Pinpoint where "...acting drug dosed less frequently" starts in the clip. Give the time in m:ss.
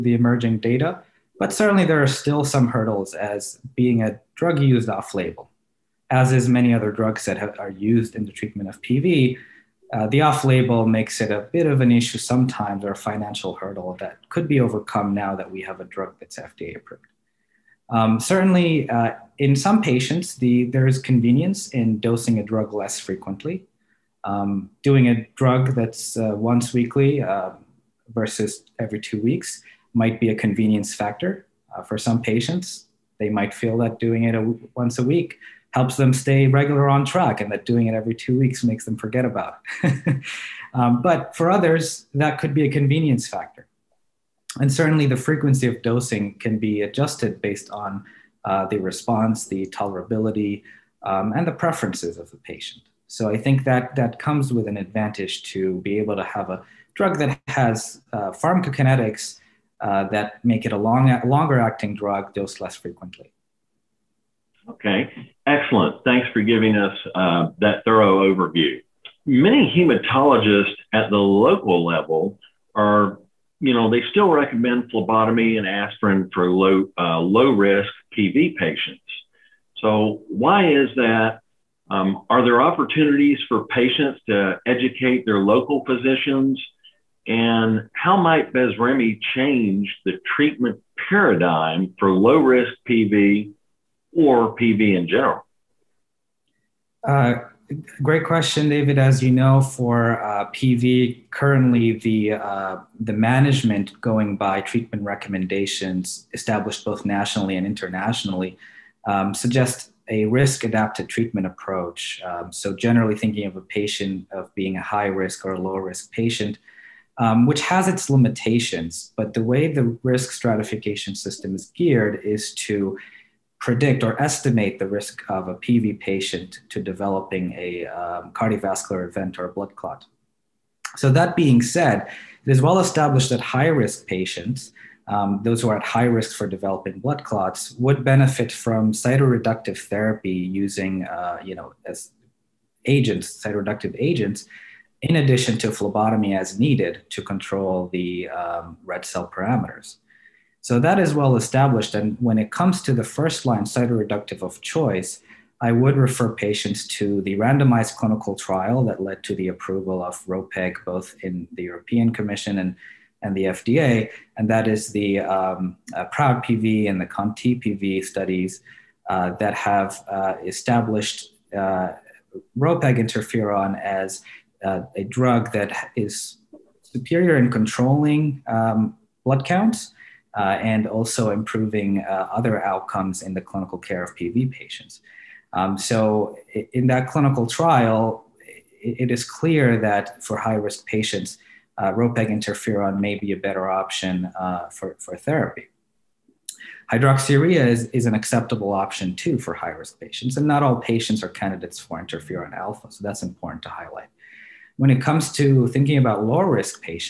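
1:01.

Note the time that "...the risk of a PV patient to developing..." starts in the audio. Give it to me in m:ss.
2:04.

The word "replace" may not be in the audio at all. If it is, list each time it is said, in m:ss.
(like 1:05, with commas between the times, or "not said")
not said.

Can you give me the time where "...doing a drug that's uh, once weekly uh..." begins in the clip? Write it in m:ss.
0:24.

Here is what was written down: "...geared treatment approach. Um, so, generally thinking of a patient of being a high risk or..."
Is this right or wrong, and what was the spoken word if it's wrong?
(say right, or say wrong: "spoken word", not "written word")
wrong: "adapted", not "geared".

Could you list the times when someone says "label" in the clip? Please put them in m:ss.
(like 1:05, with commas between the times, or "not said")
0:05, 0:10.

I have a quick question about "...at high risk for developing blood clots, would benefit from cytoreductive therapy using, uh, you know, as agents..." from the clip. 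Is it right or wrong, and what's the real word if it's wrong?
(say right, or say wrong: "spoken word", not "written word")
right.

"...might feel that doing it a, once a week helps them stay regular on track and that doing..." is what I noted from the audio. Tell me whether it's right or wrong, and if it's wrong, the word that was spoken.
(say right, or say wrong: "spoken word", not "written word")
right.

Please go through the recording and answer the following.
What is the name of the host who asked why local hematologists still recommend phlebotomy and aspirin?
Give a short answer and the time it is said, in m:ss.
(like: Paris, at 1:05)
David, at 1:38.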